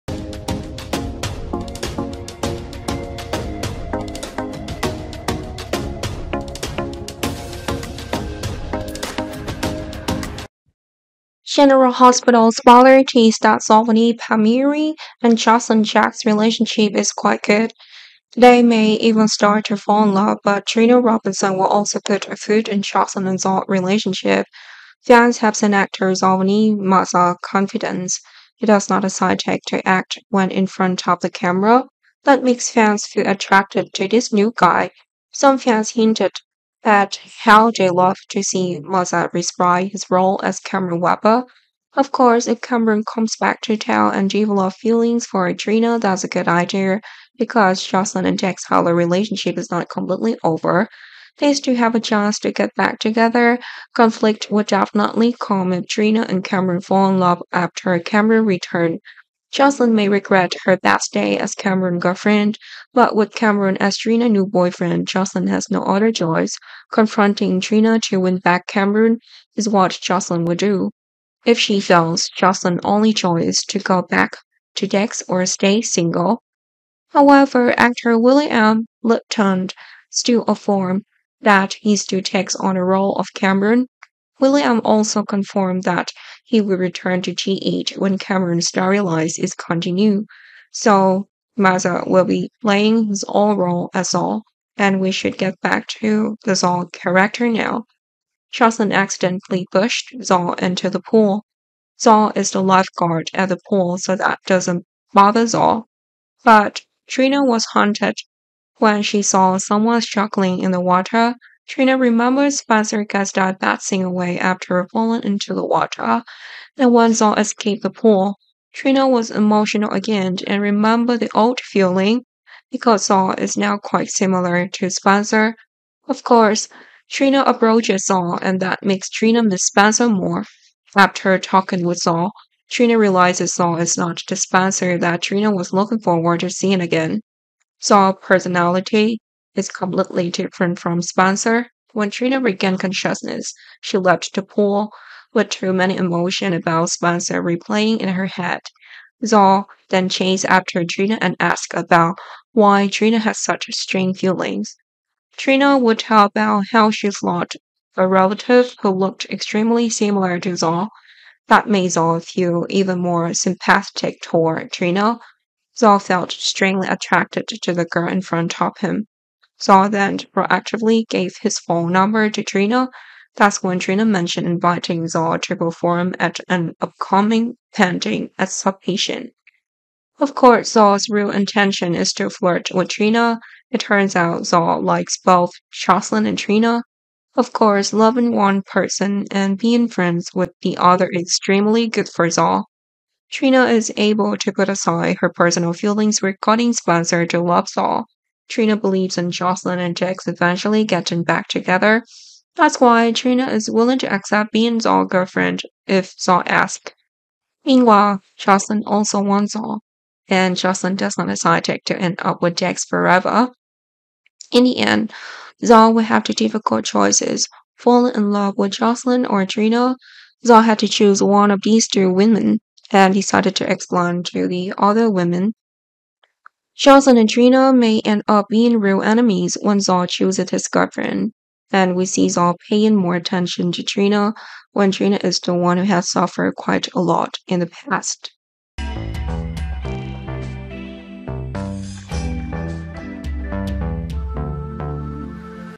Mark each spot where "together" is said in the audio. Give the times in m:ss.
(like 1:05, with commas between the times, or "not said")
0:52, 3:21.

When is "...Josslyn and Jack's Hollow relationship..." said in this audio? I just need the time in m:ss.
0:47.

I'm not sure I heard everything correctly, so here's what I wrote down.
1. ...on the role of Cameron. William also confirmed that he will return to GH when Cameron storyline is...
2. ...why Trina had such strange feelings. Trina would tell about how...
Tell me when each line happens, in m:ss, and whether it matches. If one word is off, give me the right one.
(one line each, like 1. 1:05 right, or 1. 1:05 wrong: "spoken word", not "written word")
1. 1:22 right
2. 2:32 right.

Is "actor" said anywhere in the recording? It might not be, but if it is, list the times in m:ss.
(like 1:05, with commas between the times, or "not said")
0:25, 1:17.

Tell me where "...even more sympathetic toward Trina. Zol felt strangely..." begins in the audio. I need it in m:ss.
2:42.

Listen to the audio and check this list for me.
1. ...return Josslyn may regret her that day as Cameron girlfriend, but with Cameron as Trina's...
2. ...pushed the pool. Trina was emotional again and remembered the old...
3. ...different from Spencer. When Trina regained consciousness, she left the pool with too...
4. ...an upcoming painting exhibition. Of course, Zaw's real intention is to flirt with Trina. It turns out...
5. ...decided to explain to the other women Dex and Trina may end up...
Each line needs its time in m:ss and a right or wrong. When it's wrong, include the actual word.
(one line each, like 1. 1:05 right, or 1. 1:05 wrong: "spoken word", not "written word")
1. 0:58 right
2. 1:57 wrong: "escaped", not "pushed"
3. 2:20 right
4. 2:56 right
5. 3:43 wrong: "Charles", not "Dex".